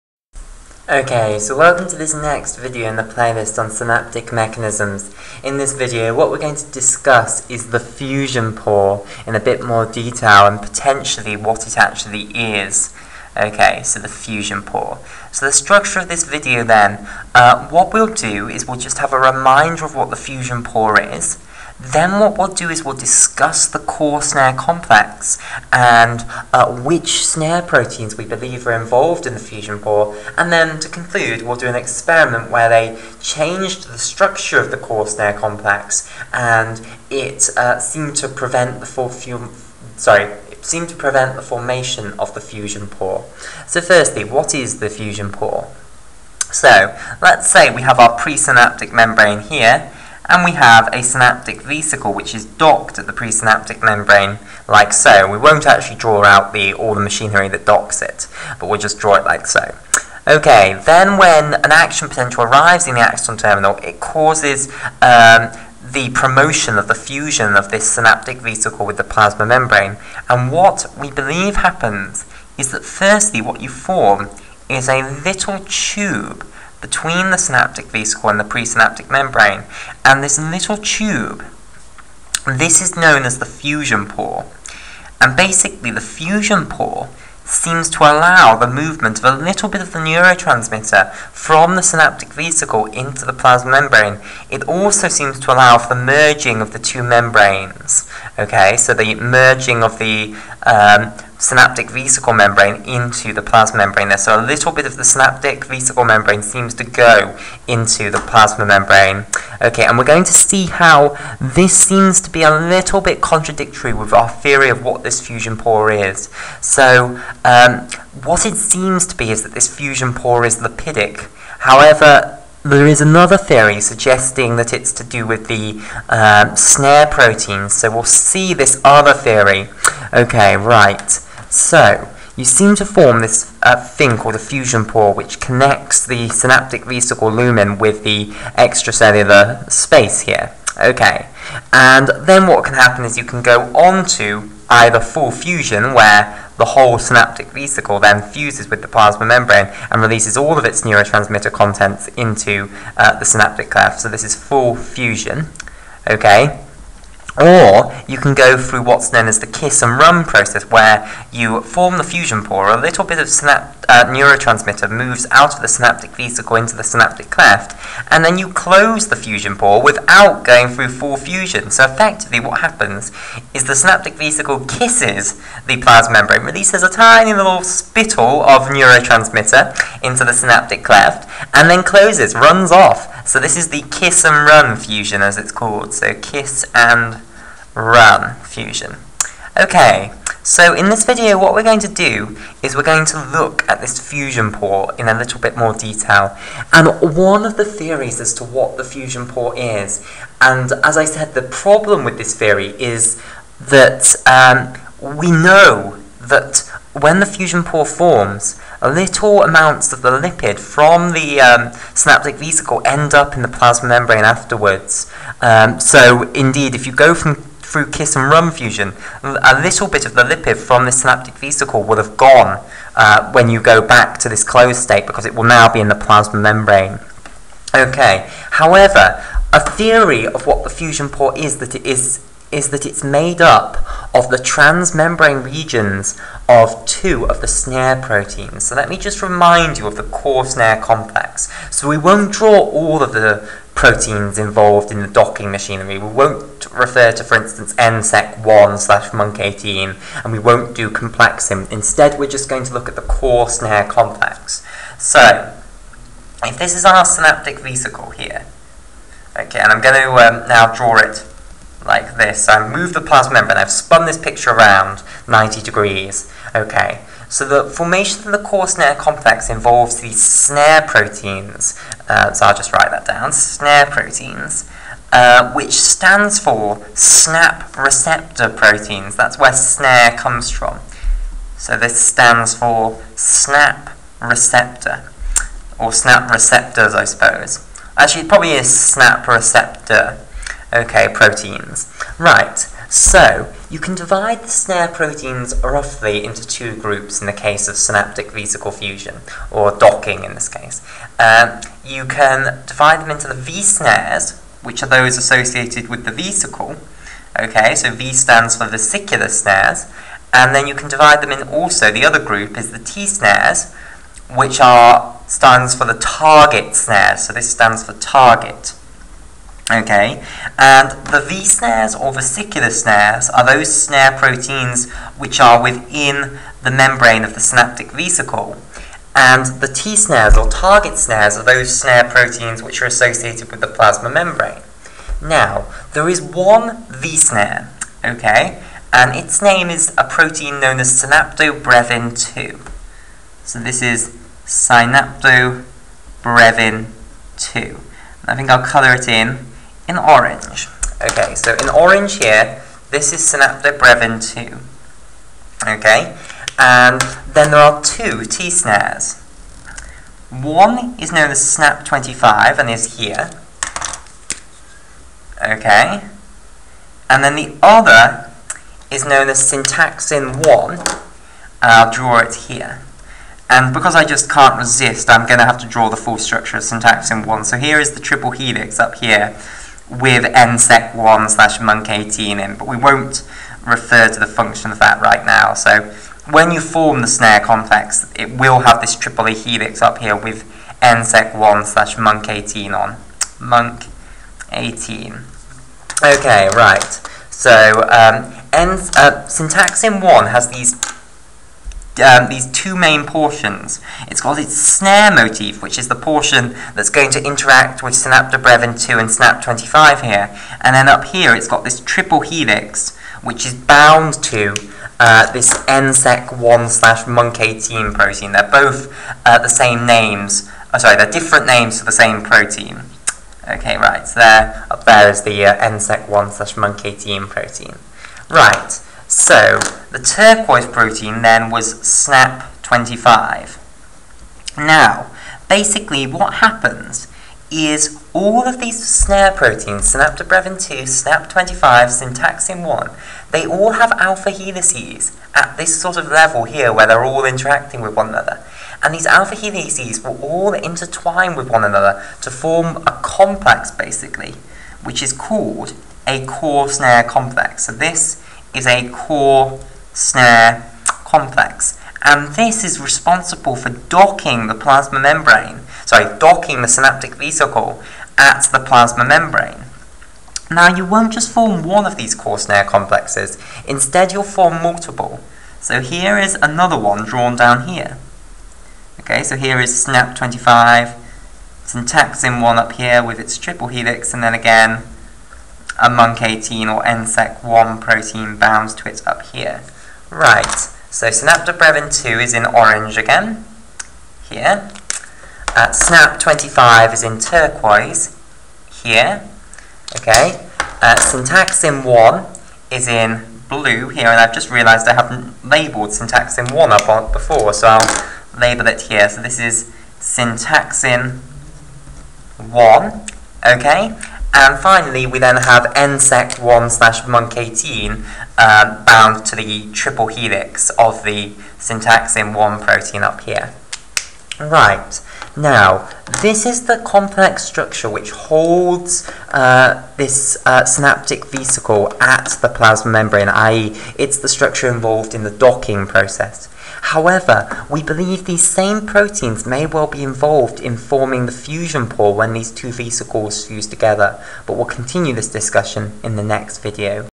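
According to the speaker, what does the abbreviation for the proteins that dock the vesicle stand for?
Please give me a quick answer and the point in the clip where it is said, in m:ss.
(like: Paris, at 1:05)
snap receptor proteins, at 4:36.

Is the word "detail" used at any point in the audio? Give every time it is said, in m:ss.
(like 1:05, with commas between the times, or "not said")
0:09, 3:15.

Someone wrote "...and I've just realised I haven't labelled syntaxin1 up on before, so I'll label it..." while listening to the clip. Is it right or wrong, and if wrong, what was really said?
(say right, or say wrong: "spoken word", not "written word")
right.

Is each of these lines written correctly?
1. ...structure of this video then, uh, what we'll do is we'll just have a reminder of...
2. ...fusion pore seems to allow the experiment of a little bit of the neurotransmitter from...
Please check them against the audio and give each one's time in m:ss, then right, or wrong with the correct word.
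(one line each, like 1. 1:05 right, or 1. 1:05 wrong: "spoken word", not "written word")
1. 0:15 right
2. 1:26 wrong: "movement", not "experiment".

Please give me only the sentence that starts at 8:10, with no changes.
Right, so synaptobrevin2 is in orange again, here.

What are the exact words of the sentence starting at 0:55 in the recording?
We won't actually draw out the, all the machinery that docks it, but we'll just draw it like so.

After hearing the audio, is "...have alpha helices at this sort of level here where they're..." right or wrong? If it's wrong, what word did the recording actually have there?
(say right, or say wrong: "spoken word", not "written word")
right.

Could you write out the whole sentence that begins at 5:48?
I think I'll colour it in in orange.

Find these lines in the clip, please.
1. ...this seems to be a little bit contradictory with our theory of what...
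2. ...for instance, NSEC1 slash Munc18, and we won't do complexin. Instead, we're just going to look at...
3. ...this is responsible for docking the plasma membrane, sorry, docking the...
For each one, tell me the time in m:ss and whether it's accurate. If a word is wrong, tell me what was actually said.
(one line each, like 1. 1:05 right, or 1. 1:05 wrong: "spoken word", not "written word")
1. 1:51 right
2. 4:07 right
3. 7:42 right.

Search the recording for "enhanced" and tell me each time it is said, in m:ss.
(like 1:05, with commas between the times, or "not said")
not said.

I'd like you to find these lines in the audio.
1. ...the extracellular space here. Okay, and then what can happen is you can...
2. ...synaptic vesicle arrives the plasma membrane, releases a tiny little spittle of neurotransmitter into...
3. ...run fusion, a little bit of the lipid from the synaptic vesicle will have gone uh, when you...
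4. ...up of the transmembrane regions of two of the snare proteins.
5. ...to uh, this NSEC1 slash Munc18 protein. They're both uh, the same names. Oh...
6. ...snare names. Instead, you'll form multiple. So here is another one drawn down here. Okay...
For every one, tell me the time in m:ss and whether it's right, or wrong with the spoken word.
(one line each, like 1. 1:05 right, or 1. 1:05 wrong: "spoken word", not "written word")
1. 2:18 right
2. 2:53 wrong: "kisses", not "arrives"
3. 3:38 right
4. 3:53 right
5. 6:54 right
6. 7:52 wrong: "complexes", not "names".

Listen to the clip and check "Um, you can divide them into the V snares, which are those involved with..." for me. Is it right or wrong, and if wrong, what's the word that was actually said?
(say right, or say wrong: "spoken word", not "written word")
wrong: "associated", not "involved".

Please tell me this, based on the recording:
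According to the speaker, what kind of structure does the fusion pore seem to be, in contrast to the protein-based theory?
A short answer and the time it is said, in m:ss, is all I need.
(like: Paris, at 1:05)
lipidic, at 2:00.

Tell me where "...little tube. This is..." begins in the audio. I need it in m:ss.
1:20.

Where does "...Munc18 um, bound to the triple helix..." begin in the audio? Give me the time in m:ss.
8:37.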